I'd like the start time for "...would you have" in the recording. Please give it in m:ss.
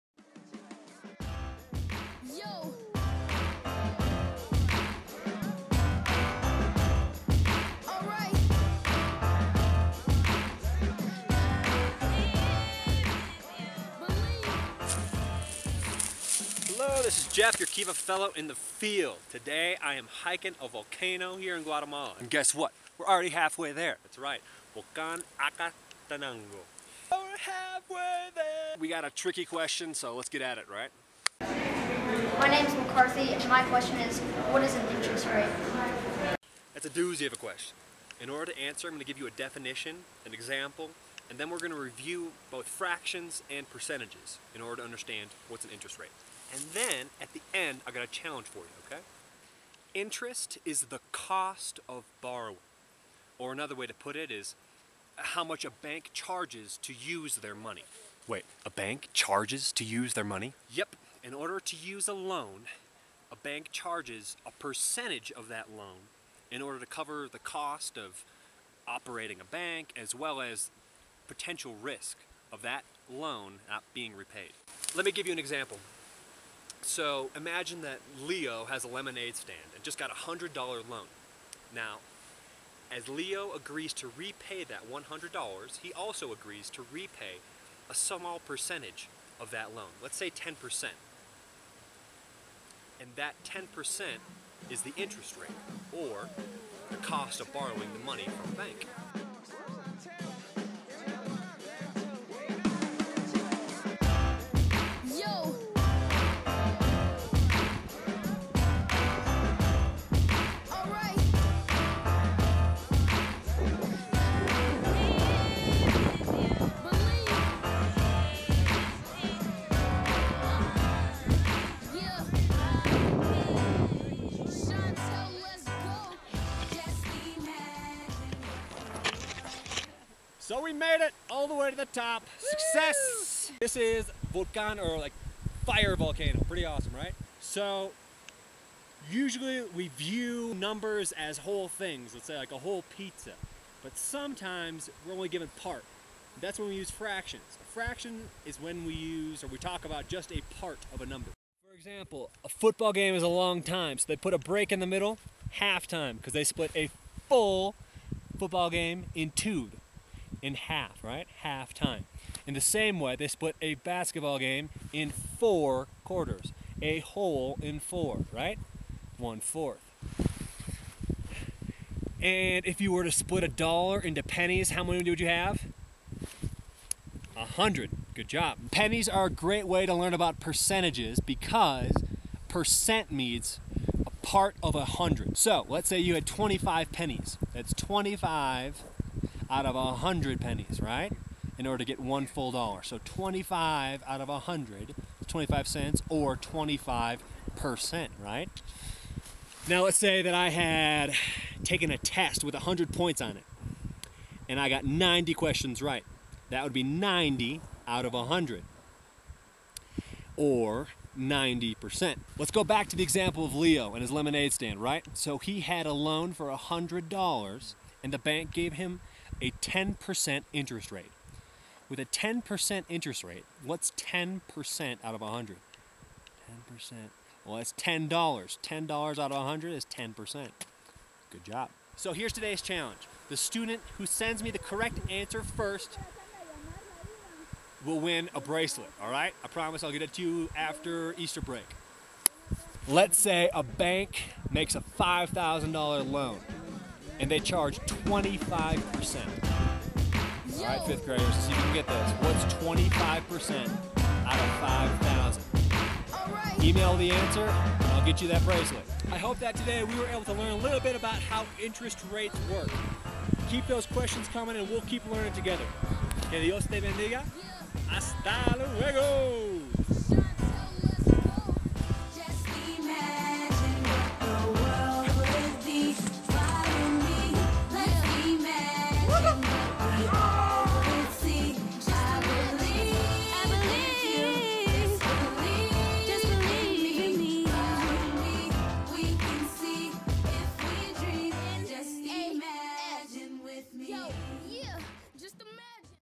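2:55.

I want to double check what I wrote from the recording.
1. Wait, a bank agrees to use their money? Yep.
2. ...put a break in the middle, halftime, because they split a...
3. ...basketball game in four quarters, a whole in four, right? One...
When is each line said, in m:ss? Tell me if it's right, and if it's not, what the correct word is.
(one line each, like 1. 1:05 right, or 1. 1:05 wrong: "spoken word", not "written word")
1. 0:58 wrong: "charges", not "agrees"
2. 2:34 right
3. 2:43 right.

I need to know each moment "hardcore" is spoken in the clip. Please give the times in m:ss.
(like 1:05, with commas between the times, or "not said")
not said.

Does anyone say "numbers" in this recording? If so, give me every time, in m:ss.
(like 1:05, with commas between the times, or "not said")
2:20, 2:31.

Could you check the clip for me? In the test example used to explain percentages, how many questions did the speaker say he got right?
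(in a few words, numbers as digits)
90.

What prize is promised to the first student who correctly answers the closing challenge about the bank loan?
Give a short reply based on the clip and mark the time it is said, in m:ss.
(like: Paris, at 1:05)
a bracelet, at 3:58.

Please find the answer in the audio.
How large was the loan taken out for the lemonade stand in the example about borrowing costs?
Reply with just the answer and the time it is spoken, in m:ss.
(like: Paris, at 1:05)
$100, at 1:20.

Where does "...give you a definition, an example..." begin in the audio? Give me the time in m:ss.
0:39.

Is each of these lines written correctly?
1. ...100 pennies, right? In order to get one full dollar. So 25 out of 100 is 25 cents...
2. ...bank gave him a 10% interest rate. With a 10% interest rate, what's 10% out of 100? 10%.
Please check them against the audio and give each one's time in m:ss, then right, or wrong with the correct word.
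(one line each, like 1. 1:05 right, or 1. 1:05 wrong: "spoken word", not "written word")
1. 3:09 right
2. 3:38 right.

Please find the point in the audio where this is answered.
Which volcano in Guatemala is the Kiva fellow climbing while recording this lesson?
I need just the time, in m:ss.
0:24.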